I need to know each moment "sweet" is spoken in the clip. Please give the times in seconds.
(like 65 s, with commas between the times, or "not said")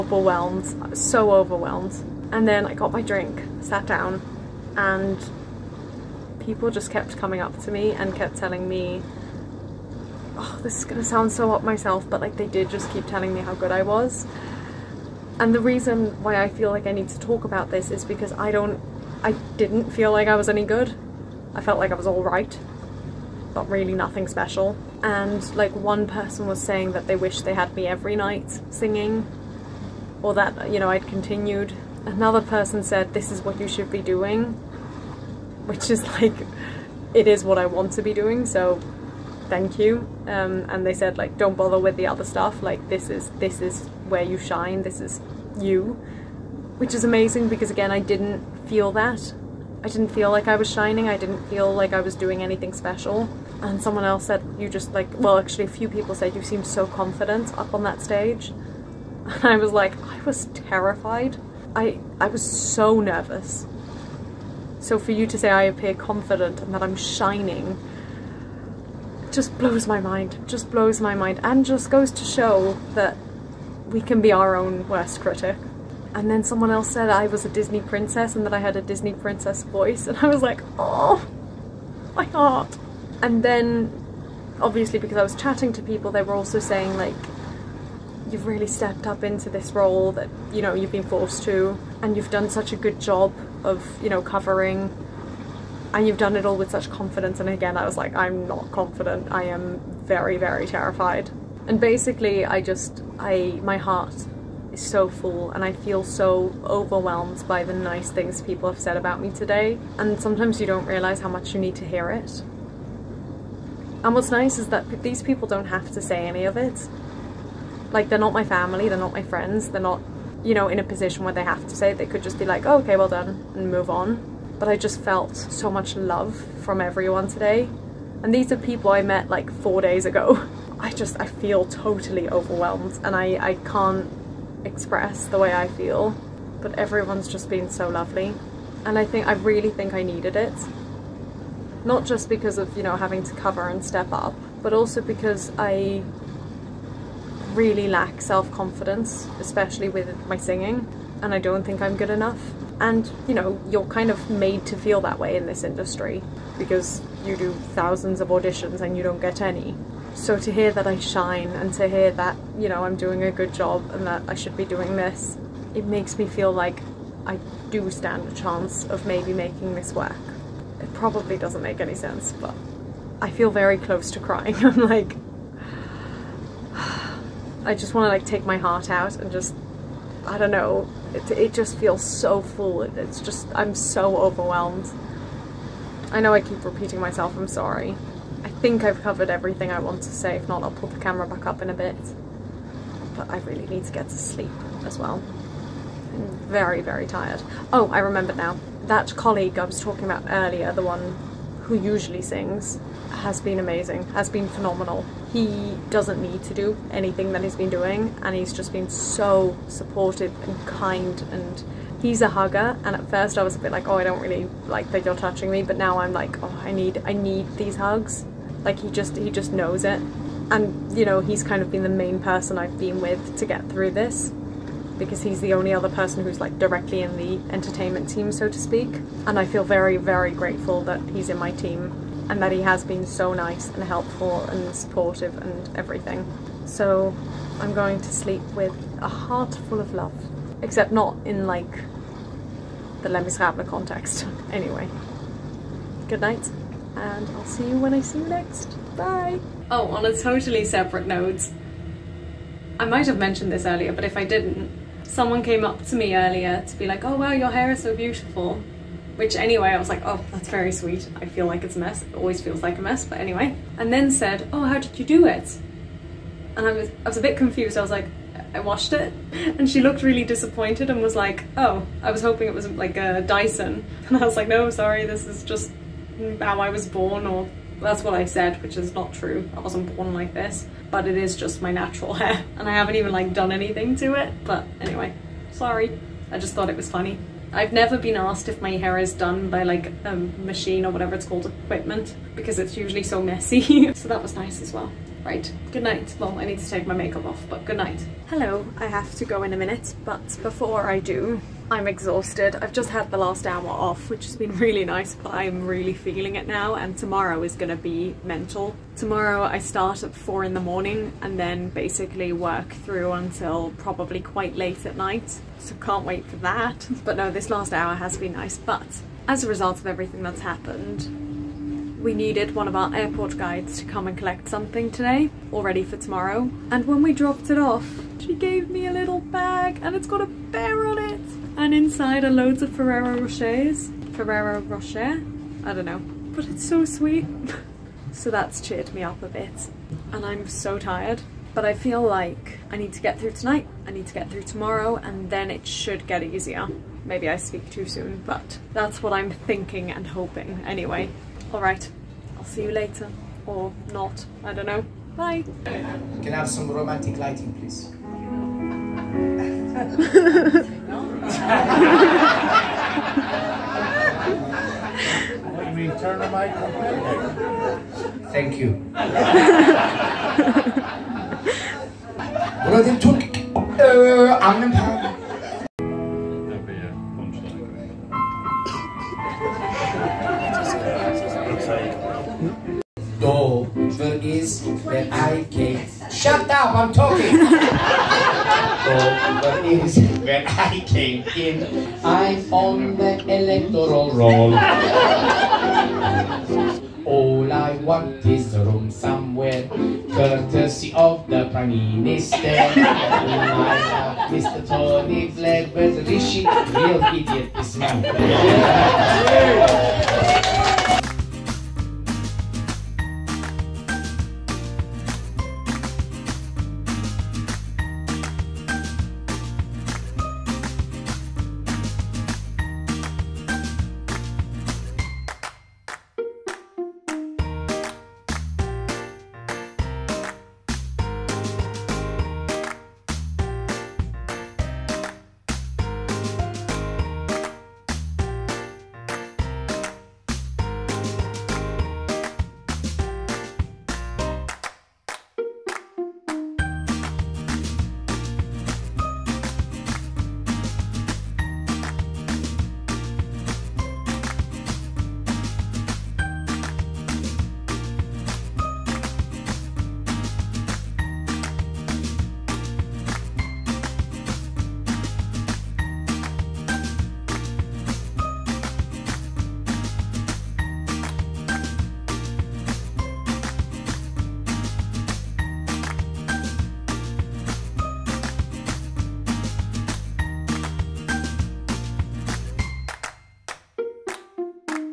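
260 s, 336 s.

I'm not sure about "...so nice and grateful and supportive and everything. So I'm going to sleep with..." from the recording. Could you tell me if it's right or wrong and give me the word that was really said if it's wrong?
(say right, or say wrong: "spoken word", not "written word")
wrong: "helpful", not "grateful".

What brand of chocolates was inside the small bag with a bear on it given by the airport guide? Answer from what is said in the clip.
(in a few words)
Ferrero Rocher.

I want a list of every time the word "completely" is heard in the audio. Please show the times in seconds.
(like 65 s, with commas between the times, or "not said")
368 s.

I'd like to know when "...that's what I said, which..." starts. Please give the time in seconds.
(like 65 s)
277 s.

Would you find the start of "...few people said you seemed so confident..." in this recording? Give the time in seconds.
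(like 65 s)
55 s.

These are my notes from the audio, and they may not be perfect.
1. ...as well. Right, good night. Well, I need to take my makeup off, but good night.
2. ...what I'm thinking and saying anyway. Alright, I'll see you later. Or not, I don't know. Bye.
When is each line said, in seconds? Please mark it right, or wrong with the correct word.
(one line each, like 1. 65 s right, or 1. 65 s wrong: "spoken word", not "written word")
1. 294 s right
2. 349 s wrong: "hoping", not "saying".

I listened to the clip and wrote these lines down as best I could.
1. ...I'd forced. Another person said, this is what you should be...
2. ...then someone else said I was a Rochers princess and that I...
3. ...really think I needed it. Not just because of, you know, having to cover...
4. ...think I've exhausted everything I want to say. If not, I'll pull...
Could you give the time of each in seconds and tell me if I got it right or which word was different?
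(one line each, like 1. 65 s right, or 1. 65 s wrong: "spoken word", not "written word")
1. 30 s wrong: "continued", not "forced"
2. 76 s wrong: "Disney", not "Rochers"
3. 139 s right
4. 188 s wrong: "covered", not "exhausted".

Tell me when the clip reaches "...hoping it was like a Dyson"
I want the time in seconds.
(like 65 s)
272 s.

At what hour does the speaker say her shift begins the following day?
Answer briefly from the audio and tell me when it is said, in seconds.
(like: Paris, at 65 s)
4 in the morning, at 310 s.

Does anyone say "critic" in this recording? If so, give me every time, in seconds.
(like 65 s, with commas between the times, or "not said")
75 s.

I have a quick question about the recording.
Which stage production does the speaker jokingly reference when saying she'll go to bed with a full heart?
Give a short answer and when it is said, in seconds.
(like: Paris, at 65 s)
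Les Miserables, at 243 s.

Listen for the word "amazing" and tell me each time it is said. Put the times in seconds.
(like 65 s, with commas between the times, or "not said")
47 s, 203 s.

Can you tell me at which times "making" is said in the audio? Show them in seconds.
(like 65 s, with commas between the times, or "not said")
169 s.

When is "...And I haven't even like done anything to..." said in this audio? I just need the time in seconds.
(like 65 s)
282 s.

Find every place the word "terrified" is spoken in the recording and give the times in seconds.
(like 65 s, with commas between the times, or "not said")
60 s, 100 s.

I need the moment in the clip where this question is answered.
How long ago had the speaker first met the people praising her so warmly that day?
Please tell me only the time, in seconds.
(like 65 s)
129 s.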